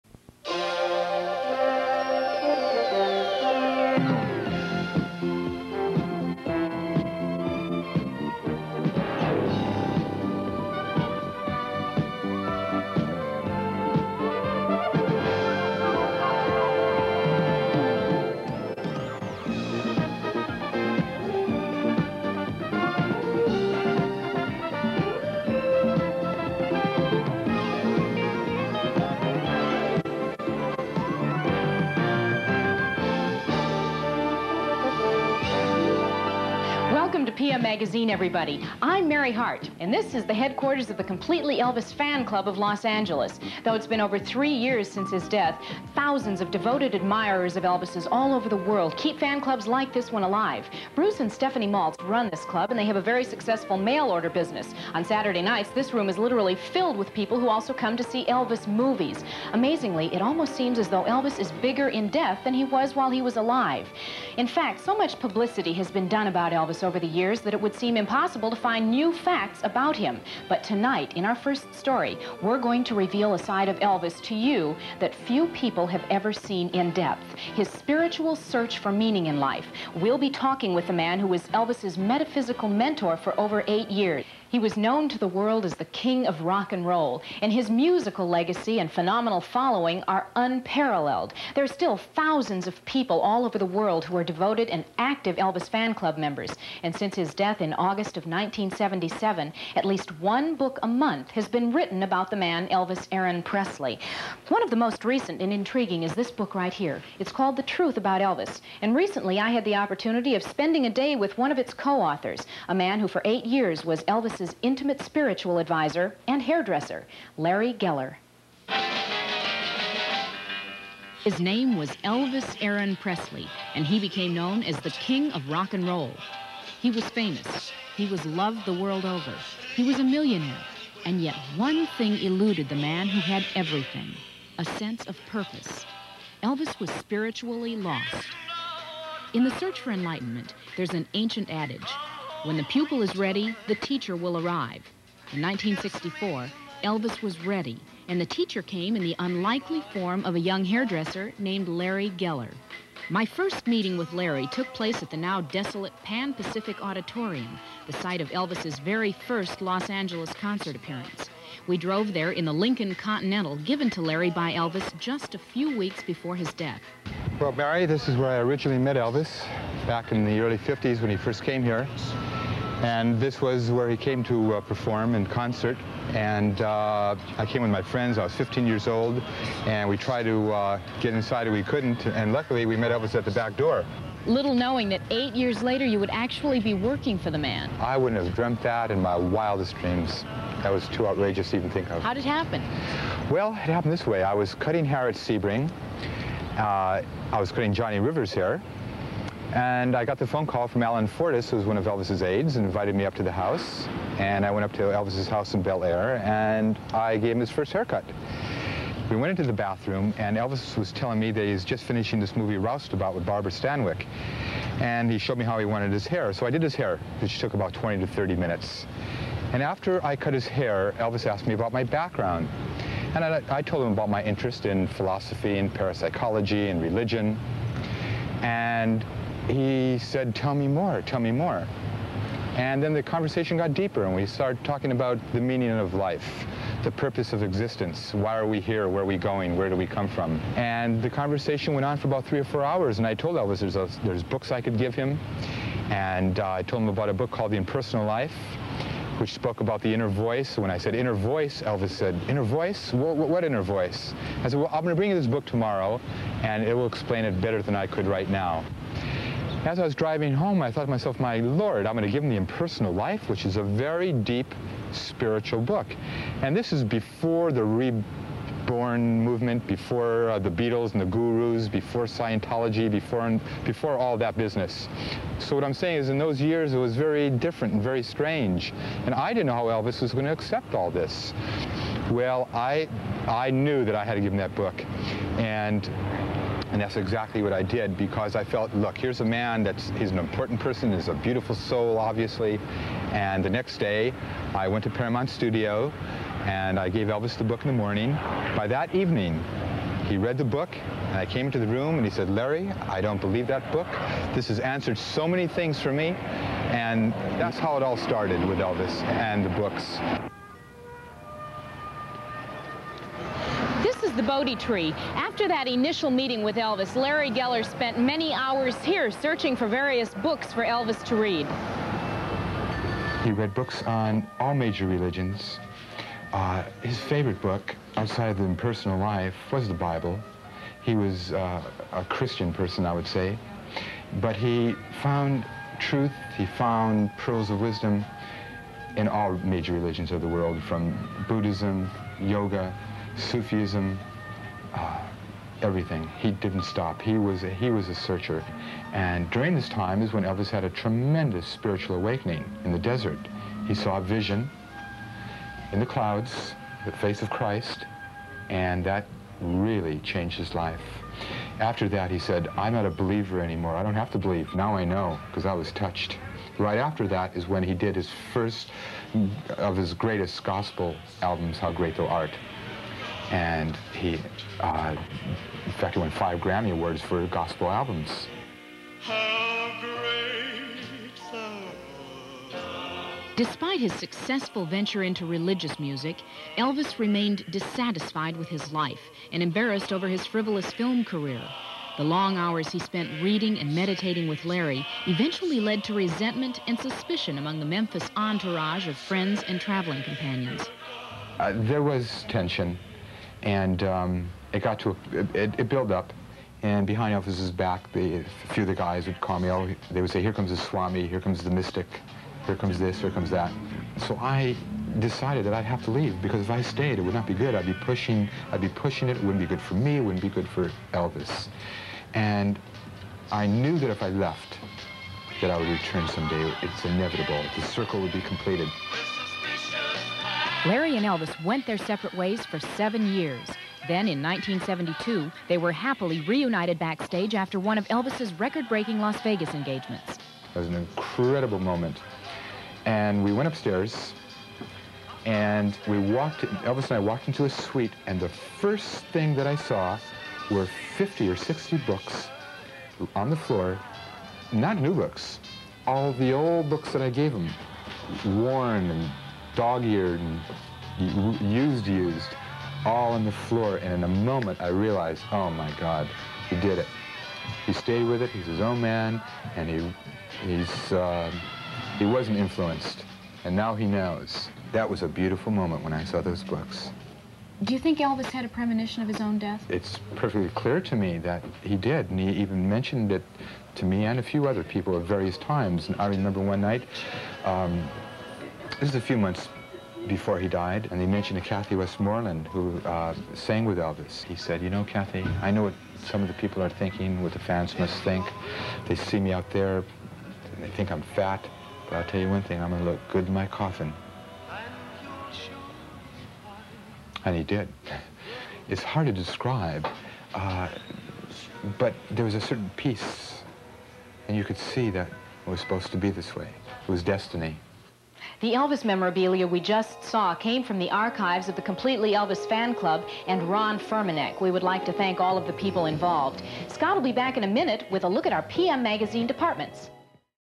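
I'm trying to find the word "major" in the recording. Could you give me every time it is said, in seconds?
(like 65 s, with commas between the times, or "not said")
324 s, 339 s.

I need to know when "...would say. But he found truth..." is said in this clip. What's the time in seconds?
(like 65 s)
332 s.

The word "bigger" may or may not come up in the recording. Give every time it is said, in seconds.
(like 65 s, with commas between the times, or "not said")
61 s.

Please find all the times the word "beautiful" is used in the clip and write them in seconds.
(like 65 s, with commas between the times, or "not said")
291 s, 475 s.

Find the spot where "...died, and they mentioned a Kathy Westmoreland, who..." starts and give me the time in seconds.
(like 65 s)
490 s.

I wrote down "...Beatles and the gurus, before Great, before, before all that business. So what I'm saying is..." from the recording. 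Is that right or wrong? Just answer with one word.
wrong.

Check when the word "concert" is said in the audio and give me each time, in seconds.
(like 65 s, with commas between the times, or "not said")
160 s, 175 s.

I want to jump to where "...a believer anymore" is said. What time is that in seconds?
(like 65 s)
362 s.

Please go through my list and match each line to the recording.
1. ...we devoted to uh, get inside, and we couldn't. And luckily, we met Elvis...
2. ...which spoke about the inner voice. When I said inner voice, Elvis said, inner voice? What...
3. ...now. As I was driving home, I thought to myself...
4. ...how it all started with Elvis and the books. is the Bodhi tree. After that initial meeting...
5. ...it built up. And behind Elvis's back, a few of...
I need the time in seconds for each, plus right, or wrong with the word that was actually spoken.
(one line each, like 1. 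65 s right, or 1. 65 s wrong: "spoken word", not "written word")
1. 179 s wrong: "tried", not "devoted"
2. 249 s right
3. 258 s right
4. 307 s right
5. 405 s right.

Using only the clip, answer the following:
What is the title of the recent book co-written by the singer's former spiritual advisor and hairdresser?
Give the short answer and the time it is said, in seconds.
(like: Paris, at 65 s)
The Truth About Elvis, at 107 s.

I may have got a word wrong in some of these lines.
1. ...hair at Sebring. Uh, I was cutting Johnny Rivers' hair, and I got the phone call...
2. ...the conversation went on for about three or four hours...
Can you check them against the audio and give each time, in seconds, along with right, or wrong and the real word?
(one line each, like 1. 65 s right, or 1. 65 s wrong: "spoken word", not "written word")
1. 194 s right
2. 241 s right.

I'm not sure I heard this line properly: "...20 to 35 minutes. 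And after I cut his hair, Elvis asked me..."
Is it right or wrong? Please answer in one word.
wrong.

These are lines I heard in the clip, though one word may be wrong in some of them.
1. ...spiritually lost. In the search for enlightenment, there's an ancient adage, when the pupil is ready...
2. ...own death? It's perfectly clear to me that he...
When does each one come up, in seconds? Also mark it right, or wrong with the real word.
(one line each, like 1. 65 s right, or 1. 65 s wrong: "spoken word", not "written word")
1. 136 s right
2. 479 s right.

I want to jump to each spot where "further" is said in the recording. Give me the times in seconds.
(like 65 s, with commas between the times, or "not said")
not said.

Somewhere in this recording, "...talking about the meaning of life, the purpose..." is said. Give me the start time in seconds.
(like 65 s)
234 s.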